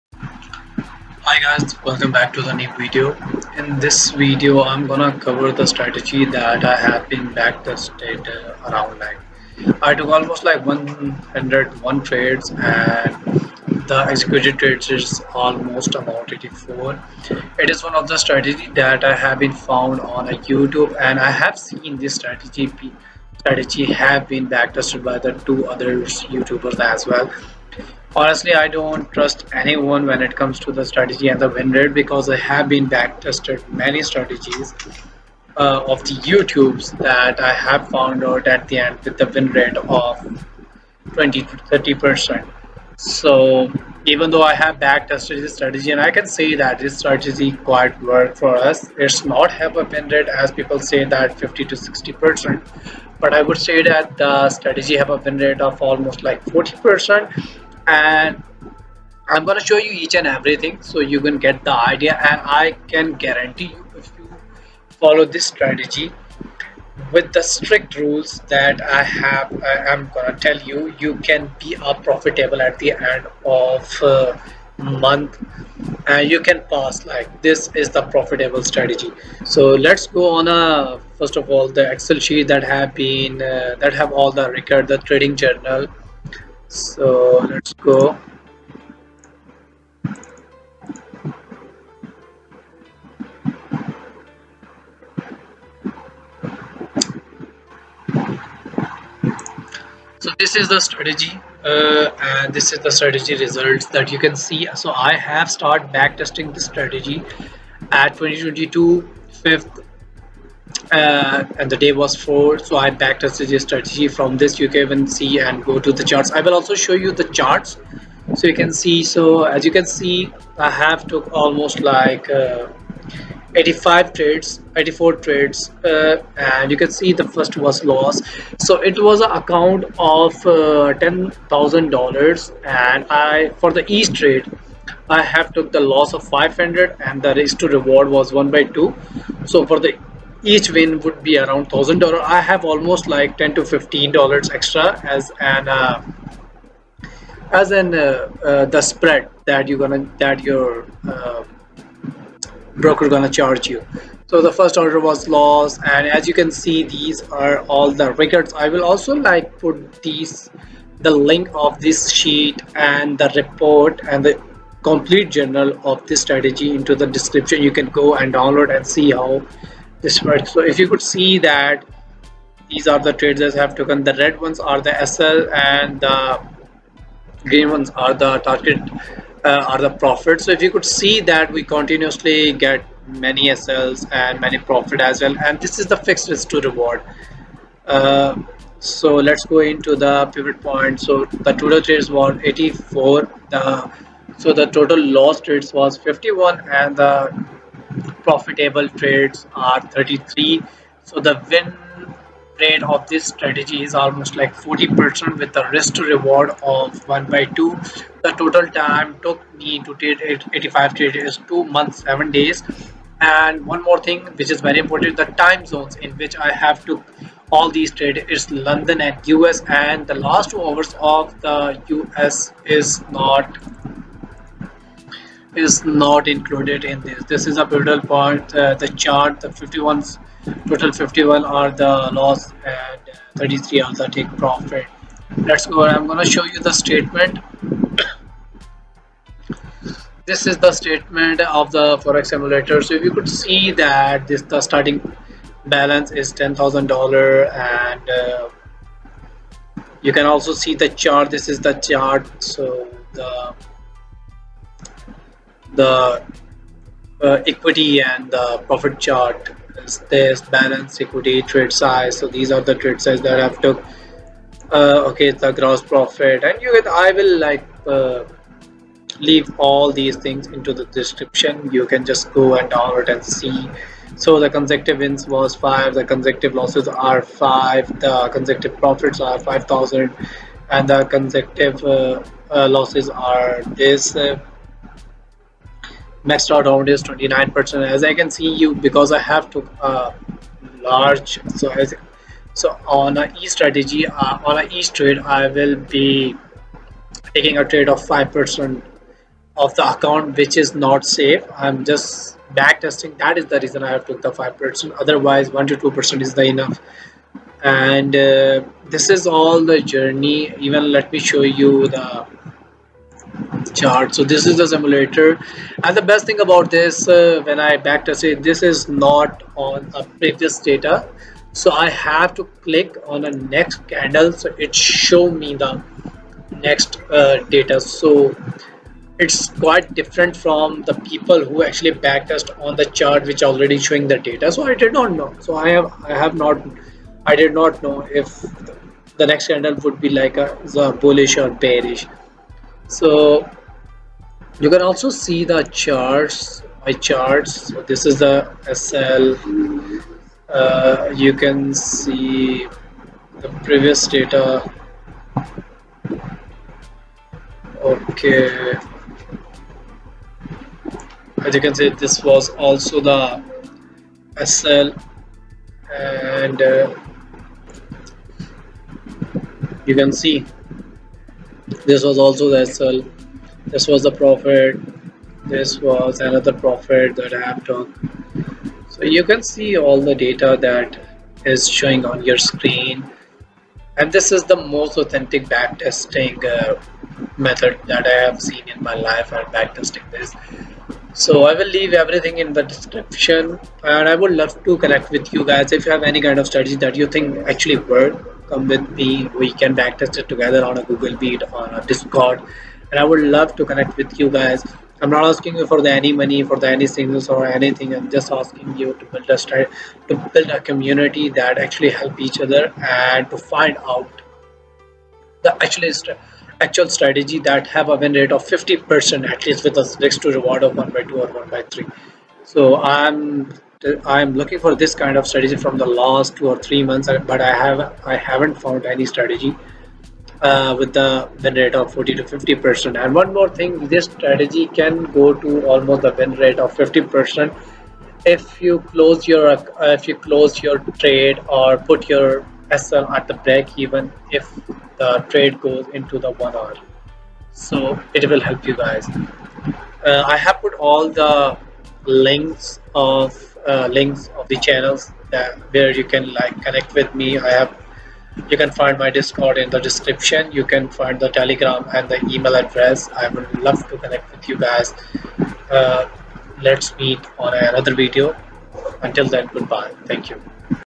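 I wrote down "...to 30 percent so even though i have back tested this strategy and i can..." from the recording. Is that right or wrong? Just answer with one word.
right.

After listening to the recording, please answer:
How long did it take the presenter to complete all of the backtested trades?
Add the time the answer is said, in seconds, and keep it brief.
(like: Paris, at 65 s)
2 months 7 days, at 211 s.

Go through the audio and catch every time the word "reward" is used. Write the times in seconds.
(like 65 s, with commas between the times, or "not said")
137 s, 186 s, 206 s, 420 s.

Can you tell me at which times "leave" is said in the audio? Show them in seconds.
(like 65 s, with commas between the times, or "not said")
269 s, 391 s.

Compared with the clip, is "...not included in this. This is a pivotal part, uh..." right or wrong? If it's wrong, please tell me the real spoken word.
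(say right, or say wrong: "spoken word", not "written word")
right.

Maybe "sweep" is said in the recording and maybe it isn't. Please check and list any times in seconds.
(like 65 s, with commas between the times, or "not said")
not said.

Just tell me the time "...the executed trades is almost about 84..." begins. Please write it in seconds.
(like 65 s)
13 s.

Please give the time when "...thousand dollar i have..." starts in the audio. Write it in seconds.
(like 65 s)
141 s.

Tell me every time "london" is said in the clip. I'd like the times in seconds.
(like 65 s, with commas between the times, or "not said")
218 s.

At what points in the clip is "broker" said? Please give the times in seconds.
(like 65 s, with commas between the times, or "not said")
152 s.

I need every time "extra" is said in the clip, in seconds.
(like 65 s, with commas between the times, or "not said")
144 s.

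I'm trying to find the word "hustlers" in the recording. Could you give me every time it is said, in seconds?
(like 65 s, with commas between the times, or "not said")
not said.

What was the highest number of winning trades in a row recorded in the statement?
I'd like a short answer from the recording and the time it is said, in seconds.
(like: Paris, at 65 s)
5, at 274 s.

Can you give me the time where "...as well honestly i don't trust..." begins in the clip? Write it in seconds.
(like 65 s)
26 s.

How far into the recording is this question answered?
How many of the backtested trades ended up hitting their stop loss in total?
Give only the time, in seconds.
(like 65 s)
194 s.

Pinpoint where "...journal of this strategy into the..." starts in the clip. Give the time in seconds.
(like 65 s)
165 s.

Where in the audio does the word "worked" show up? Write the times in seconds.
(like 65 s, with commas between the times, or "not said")
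48 s, 397 s.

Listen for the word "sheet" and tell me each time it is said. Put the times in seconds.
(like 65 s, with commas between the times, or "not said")
82 s, 162 s.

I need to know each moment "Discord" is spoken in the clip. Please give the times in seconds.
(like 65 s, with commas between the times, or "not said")
401 s, 459 s.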